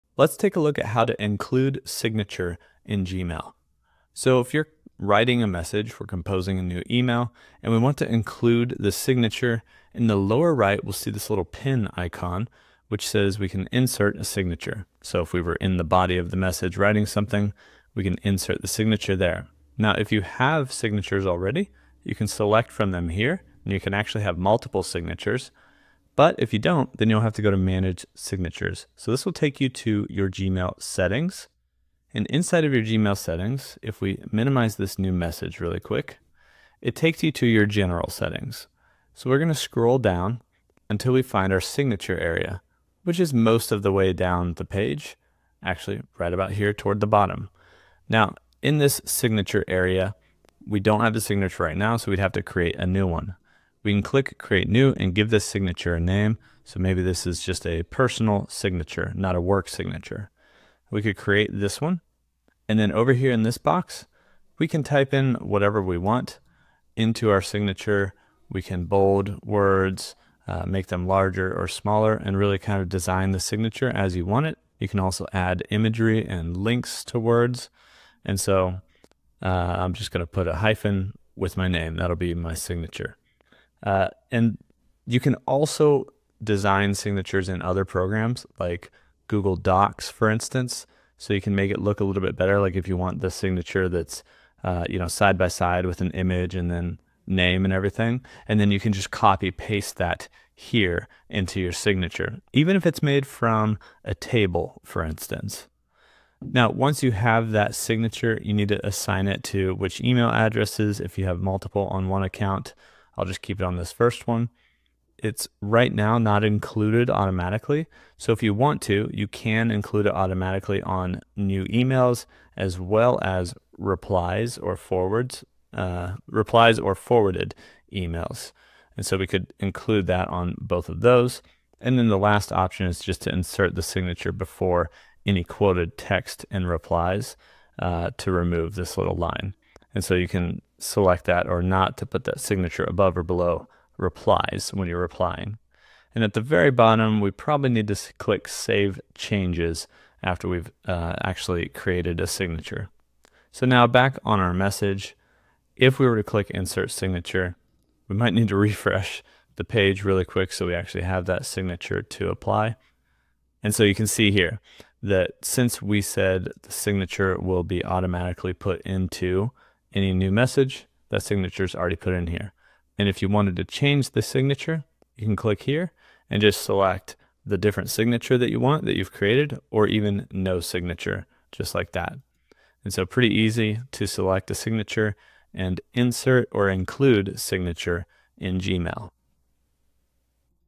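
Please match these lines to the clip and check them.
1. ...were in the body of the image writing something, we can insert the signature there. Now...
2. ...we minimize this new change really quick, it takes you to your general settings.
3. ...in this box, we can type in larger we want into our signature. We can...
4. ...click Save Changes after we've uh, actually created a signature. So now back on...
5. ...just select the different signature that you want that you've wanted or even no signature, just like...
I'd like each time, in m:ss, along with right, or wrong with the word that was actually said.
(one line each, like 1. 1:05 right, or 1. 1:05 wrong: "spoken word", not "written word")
1. 0:15 wrong: "message", not "image"
2. 0:34 wrong: "message", not "change"
3. 1:03 wrong: "whatever", not "larger"
4. 2:28 right
5. 2:56 wrong: "created", not "wanted".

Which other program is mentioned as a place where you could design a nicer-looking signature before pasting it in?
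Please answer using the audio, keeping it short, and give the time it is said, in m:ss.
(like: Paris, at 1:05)
Google Docs, at 1:29.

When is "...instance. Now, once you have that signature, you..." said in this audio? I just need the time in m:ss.
1:45.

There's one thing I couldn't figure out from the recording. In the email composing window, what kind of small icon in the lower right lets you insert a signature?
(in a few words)
pin icon.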